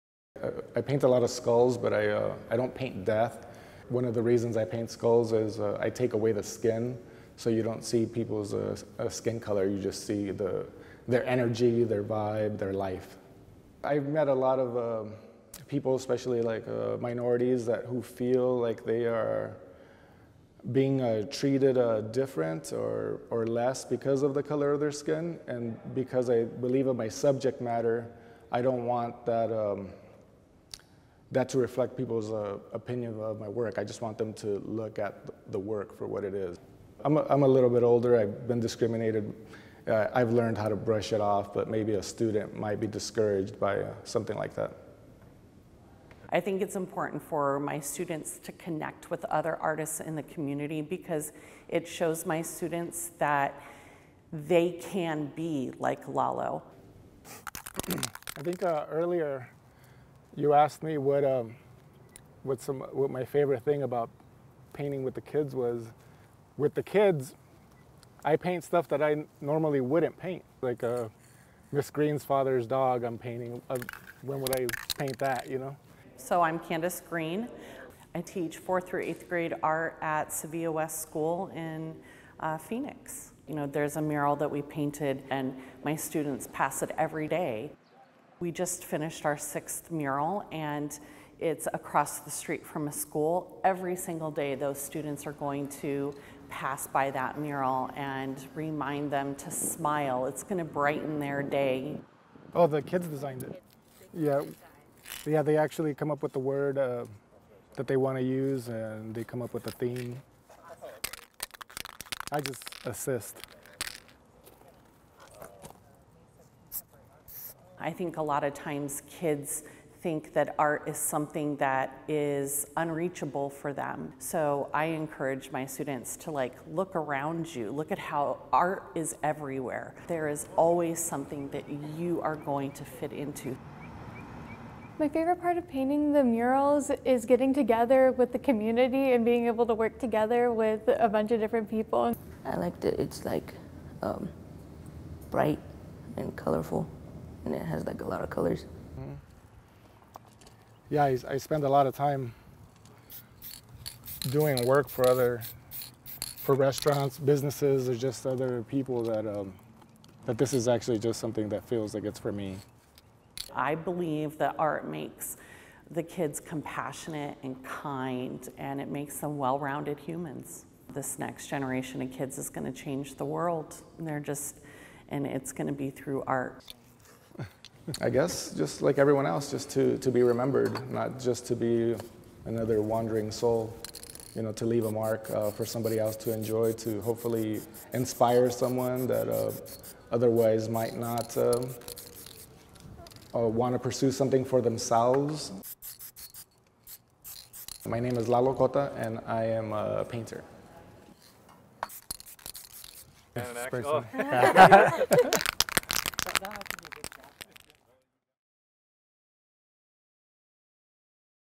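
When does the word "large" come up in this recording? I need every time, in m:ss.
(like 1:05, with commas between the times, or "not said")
not said.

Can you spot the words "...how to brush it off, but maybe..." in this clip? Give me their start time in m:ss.
0:40.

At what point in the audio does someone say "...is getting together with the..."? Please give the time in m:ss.
2:17.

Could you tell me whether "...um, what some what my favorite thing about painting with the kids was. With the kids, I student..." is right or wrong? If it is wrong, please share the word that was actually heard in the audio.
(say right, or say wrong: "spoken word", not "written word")
wrong: "paint", not "student".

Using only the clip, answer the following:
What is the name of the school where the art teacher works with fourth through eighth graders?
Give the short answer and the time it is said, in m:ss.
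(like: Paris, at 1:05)
Sevilla West School, at 1:20.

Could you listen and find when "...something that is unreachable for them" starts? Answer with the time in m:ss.
2:00.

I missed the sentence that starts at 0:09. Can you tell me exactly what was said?
You just see the, their energy, their vibe, their life.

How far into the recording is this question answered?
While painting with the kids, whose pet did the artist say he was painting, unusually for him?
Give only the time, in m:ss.
1:11.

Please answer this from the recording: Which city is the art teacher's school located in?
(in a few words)
Phoenix.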